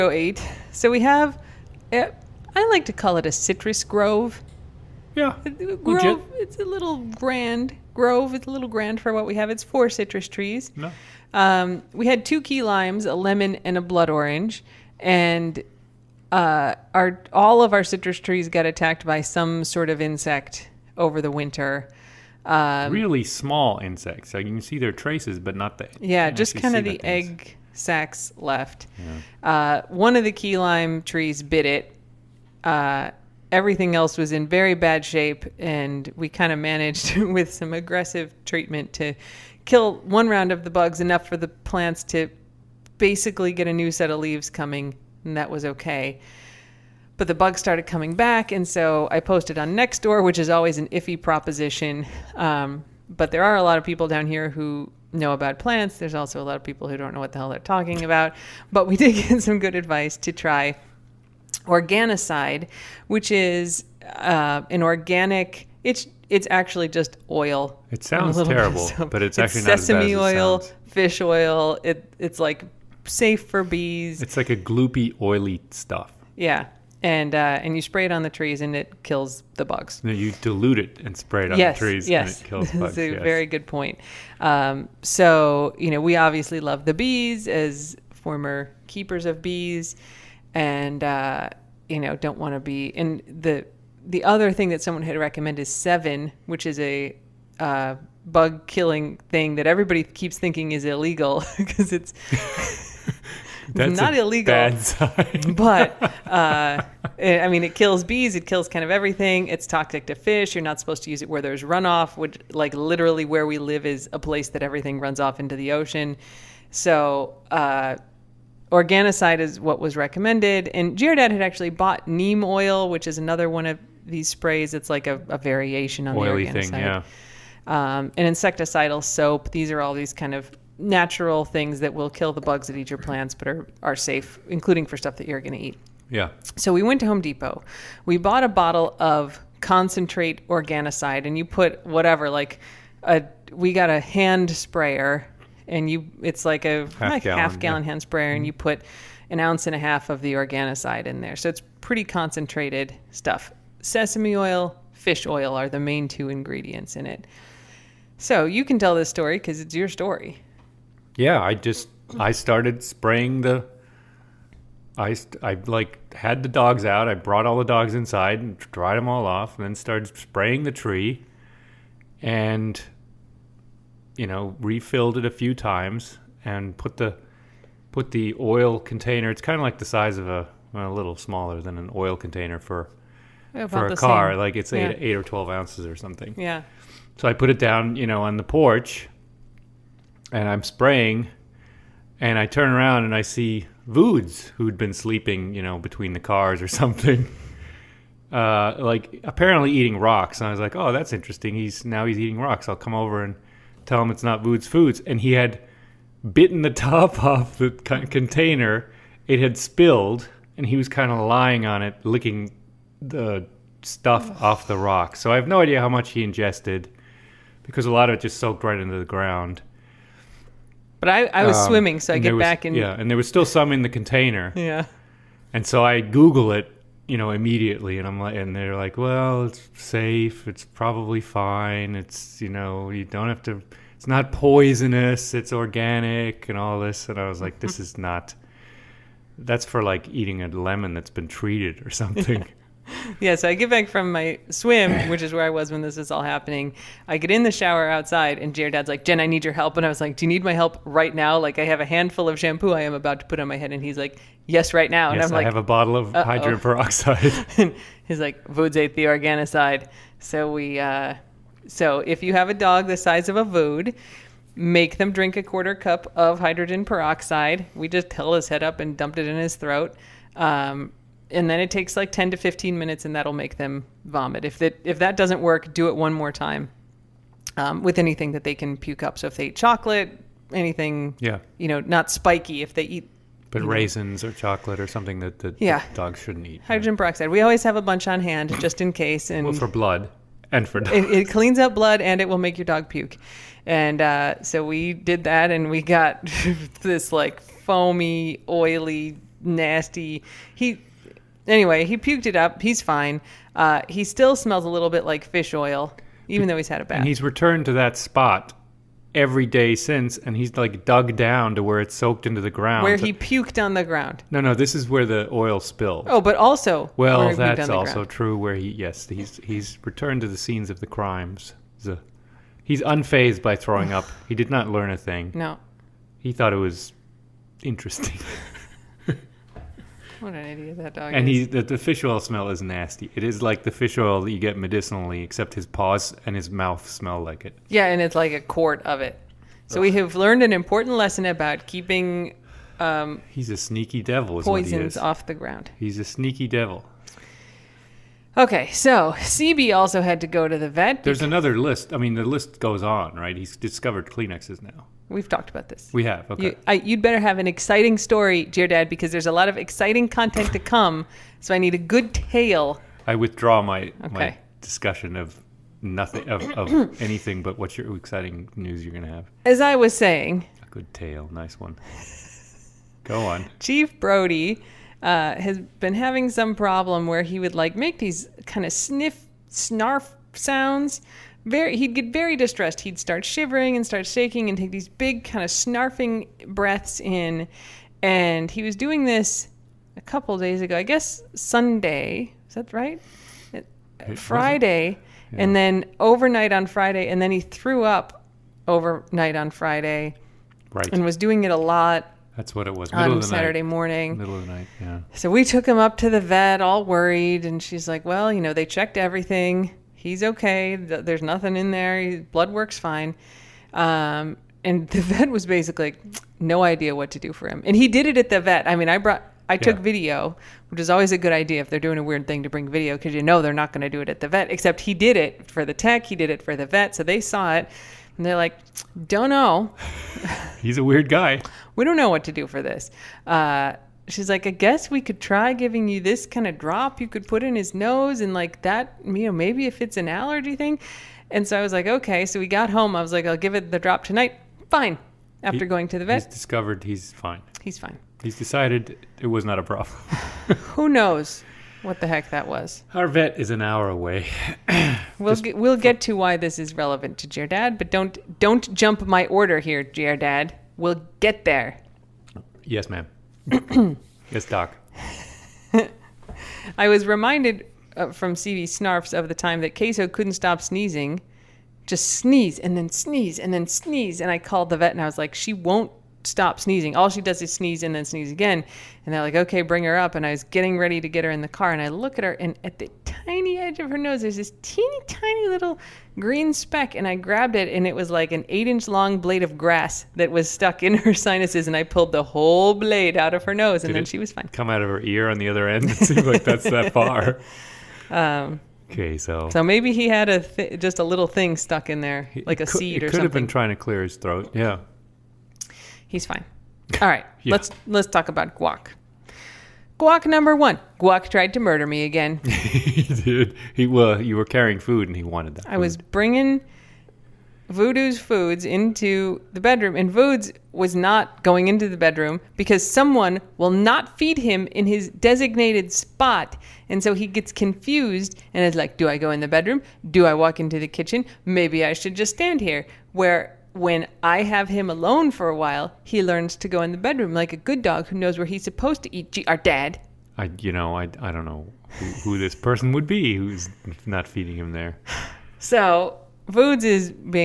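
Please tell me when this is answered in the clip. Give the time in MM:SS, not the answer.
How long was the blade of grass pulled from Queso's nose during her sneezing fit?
08:08.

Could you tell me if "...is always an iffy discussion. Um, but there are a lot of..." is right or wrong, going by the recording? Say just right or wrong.
wrong.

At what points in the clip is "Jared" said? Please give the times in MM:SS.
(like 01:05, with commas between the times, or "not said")
02:00, 04:08.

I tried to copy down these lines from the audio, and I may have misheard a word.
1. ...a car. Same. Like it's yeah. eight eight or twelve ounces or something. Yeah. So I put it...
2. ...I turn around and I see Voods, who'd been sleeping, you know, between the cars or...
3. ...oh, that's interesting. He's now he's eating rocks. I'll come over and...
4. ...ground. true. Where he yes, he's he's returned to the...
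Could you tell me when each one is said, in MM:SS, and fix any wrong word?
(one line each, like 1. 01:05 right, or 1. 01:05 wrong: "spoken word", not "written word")
1. 03:03 right
2. 03:12 right
3. 03:20 right
4. 05:17 right.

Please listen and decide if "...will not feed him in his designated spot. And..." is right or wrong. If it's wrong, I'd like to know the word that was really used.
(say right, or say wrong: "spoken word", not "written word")
right.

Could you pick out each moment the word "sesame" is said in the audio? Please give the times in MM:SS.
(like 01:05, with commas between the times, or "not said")
01:09, 02:33.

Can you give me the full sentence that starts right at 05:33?
It is like the fish oil that you get medicinally, except his paws and his mouth smell like it.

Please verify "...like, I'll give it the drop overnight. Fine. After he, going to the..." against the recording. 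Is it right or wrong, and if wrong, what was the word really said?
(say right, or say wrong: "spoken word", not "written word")
wrong: "tonight", not "overnight".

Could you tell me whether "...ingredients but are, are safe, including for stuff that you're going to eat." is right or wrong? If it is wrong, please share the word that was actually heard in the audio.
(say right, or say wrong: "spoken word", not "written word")
wrong: "plants", not "ingredients".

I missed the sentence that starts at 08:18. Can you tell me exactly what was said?
Um, Okay, so so maybe he had a th- just a little thing stuck in there, like a seed or seed.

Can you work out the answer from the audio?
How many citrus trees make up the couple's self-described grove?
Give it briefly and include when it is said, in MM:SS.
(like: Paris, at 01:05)
4, at 00:09.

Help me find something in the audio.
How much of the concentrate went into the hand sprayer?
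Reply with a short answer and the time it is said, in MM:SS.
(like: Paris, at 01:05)
1.5 ounces, at 02:29.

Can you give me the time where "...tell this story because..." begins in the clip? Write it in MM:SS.
02:38.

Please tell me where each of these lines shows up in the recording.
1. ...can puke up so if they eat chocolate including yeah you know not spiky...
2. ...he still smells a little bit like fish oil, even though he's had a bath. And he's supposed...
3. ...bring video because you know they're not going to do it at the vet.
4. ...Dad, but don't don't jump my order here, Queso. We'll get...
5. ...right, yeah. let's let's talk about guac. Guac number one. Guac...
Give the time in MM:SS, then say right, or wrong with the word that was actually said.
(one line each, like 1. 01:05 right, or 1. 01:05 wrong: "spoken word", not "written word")
1. 04:38 wrong: "anything", not "including"
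2. 05:03 wrong: "returned", not "supposed"
3. 07:02 right
4. 07:37 wrong: "Dad", not "Queso"
5. 08:27 right.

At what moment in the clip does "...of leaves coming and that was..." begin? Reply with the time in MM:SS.
00:44.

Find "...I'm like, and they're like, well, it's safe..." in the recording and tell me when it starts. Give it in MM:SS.
03:48.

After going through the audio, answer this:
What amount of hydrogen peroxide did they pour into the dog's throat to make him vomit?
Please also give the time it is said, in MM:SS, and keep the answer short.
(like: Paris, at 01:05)
Quarter cup, at 04:25.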